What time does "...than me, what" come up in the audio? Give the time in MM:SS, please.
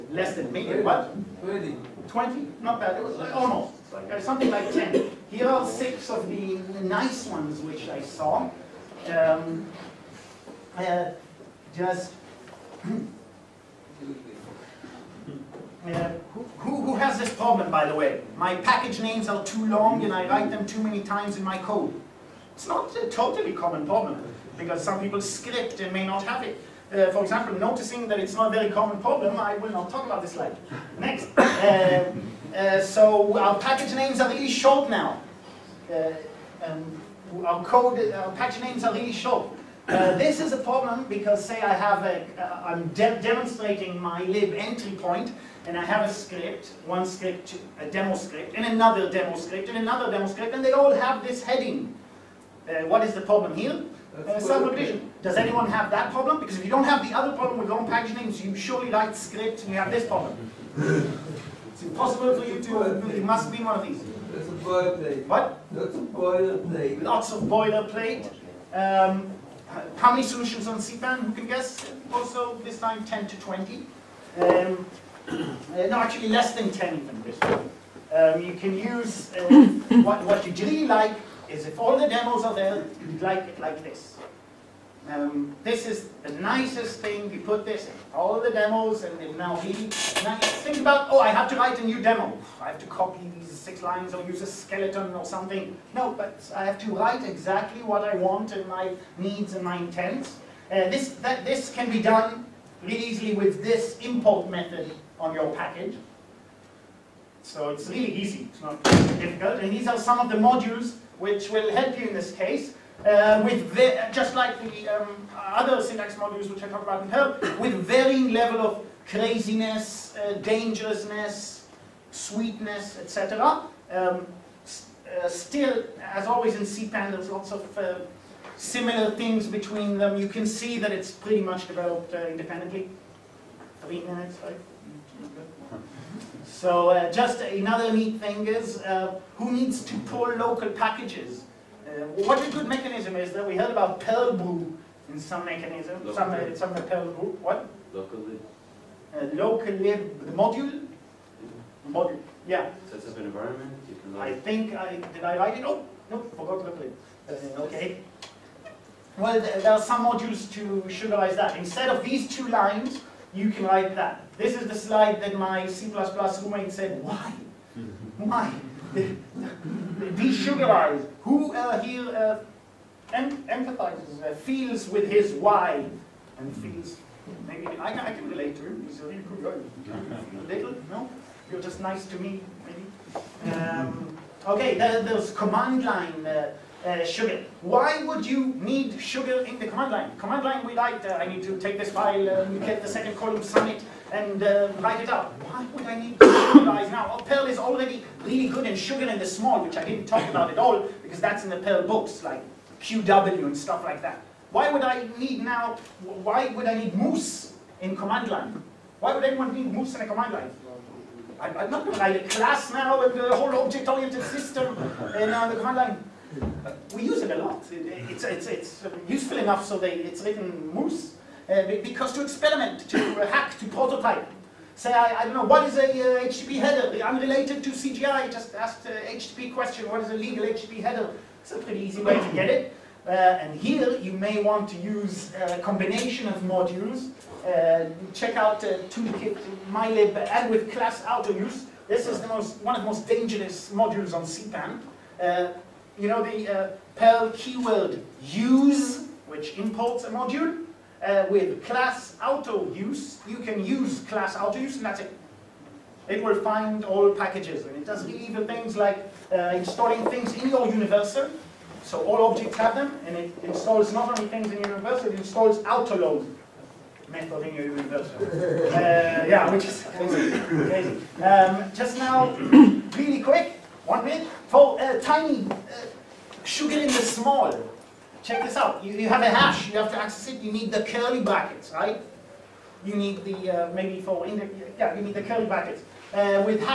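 00:00.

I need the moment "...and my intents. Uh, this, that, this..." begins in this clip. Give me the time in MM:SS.
01:39.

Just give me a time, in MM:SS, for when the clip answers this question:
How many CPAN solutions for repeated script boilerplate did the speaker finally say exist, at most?
01:16.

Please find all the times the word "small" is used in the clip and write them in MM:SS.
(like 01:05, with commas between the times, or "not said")
03:19, 04:36.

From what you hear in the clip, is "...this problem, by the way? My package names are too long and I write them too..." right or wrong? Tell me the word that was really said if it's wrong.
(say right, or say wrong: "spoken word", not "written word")
right.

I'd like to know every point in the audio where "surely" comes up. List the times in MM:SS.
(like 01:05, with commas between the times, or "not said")
00:58.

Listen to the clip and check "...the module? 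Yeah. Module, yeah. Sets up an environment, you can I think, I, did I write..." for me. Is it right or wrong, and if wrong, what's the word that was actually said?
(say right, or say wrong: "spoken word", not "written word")
right.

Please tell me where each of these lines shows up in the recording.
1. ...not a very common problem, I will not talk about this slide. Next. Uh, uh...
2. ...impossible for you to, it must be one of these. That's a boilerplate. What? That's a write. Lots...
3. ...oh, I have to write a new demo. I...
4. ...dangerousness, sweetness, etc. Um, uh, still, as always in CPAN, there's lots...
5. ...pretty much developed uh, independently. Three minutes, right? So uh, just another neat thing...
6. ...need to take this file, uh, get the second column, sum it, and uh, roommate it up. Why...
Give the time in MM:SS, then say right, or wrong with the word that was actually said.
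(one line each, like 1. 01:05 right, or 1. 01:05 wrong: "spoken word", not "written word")
1. 00:28 right
2. 01:01 wrong: "boilerplate", not "write"
3. 01:31 right
4. 02:00 right
5. 02:11 right
6. 03:11 wrong: "write", not "roommate".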